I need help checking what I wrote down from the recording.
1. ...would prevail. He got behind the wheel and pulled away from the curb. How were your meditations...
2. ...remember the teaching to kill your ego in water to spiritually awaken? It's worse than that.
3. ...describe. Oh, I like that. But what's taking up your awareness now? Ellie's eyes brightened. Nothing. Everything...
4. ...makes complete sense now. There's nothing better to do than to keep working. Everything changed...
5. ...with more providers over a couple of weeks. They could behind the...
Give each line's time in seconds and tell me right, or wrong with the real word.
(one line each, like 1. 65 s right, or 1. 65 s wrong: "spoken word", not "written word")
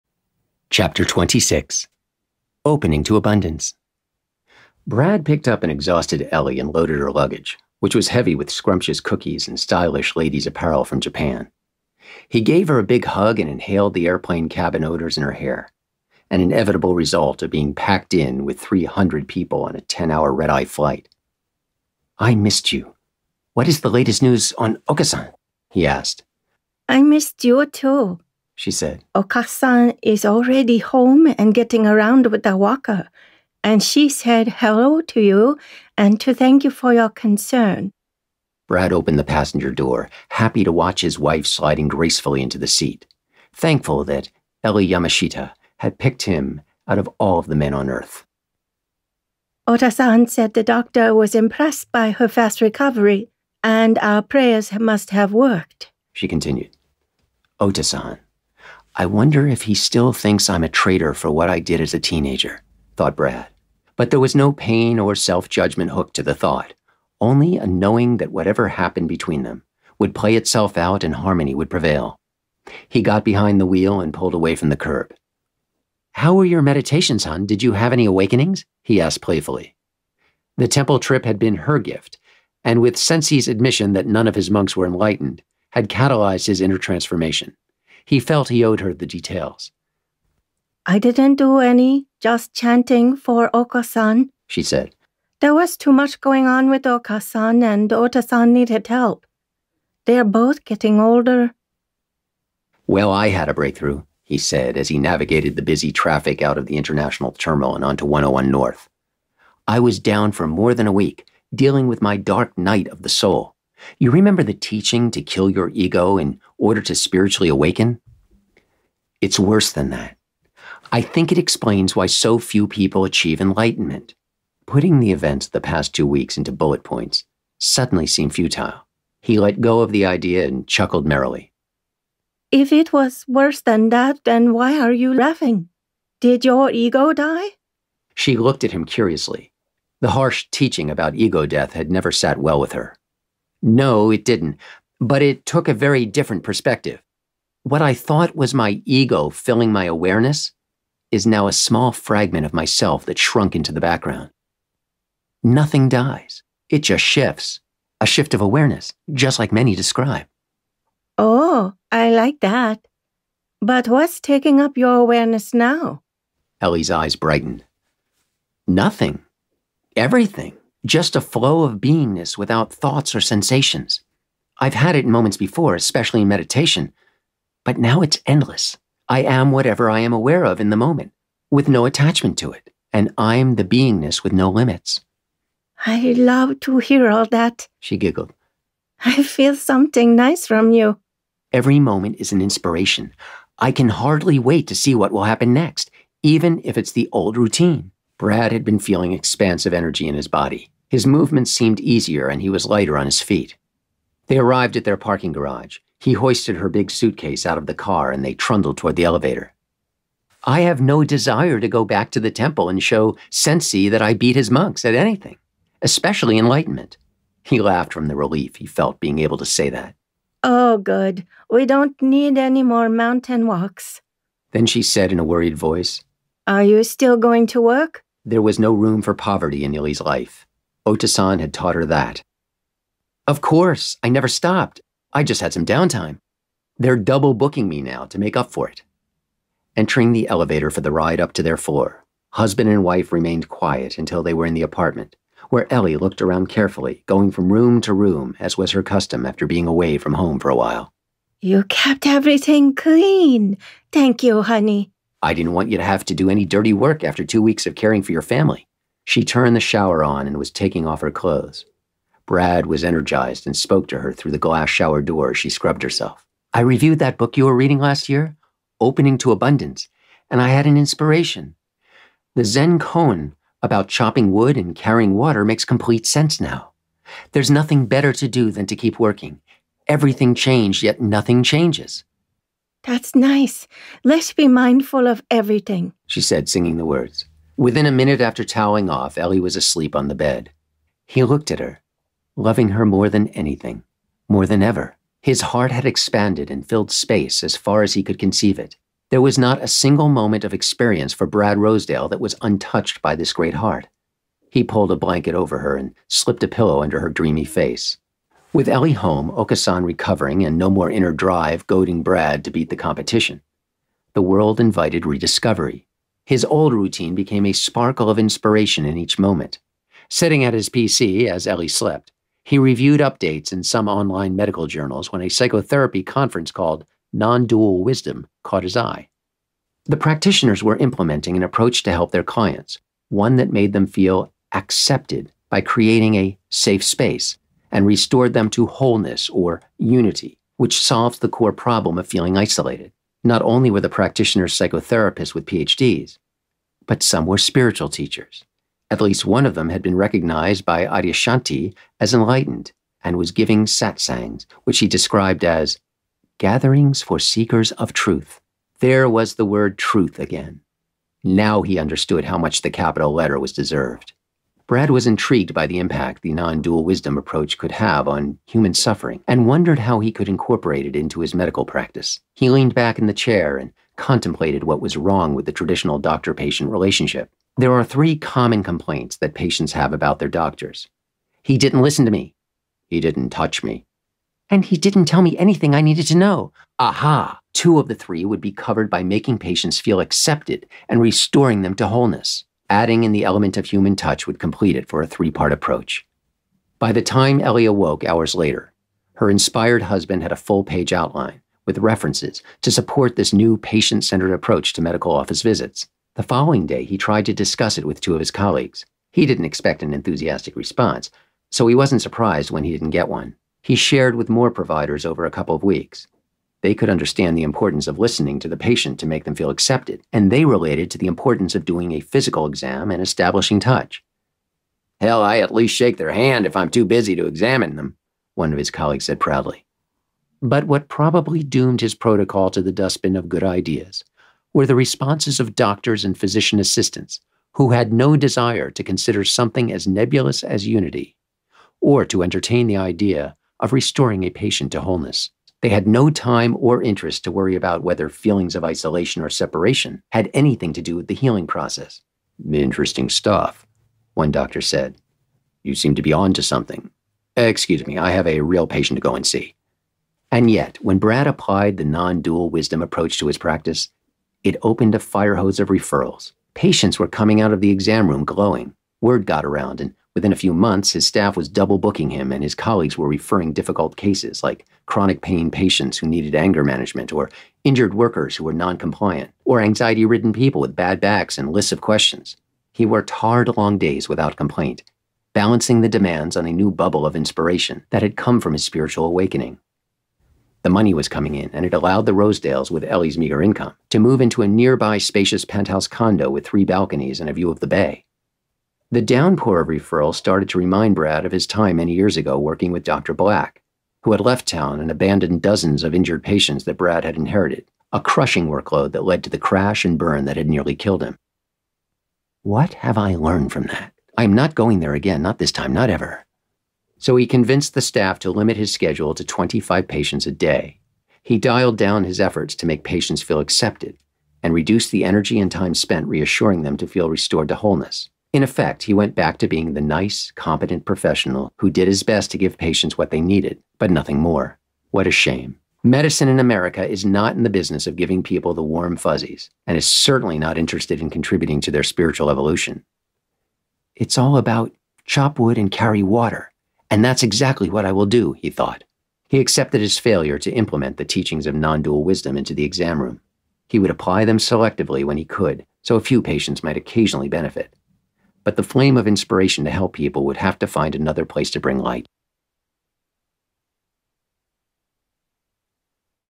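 1. 71 s right
2. 114 s wrong: "order", not "water"
3. 159 s right
4. 275 s right
5. 414 s wrong: "understand", not "behind".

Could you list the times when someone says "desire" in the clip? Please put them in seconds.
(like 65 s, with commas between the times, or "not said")
211 s, 438 s.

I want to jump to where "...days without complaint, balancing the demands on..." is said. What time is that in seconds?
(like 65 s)
483 s.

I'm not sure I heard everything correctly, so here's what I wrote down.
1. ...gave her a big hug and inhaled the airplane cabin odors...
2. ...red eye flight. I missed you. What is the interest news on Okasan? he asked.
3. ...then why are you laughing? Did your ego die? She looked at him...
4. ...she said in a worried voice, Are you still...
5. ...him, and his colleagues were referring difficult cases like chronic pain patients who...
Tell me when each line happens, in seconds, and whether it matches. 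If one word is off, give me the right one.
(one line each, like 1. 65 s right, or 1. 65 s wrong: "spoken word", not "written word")
1. 12 s right
2. 20 s wrong: "latest", not "interest"
3. 134 s right
4. 224 s right
5. 472 s right.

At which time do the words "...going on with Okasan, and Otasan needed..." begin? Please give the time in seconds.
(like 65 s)
96 s.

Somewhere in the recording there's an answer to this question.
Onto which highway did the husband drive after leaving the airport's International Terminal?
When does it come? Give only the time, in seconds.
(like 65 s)
108 s.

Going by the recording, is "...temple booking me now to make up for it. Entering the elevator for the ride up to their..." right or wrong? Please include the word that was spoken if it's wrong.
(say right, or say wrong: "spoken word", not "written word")
wrong: "double", not "temple".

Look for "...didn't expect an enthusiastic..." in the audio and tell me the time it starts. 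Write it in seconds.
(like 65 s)
409 s.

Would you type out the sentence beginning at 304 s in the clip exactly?
He pulled a blanket over her and slipped a pillow under her dreamy face.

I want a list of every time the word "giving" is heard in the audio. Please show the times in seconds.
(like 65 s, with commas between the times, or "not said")
353 s, 537 s.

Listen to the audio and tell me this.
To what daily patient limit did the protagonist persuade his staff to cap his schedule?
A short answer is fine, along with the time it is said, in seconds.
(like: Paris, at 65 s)
25, at 519 s.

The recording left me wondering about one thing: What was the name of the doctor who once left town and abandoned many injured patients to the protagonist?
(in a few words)
Dr. Black.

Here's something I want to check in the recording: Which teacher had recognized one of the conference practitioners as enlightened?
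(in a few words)
Adyashanti.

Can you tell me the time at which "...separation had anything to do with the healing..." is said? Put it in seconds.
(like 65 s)
449 s.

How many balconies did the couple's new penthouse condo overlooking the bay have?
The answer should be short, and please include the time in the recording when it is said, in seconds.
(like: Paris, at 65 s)
3, at 496 s.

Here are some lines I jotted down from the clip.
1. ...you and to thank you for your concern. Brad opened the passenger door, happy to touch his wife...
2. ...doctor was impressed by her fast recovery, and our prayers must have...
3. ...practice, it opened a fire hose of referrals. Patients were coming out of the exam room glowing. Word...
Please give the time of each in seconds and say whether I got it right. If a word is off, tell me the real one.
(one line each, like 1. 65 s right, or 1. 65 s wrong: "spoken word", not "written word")
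1. 35 s wrong: "watch", not "touch"
2. 50 s right
3. 463 s right.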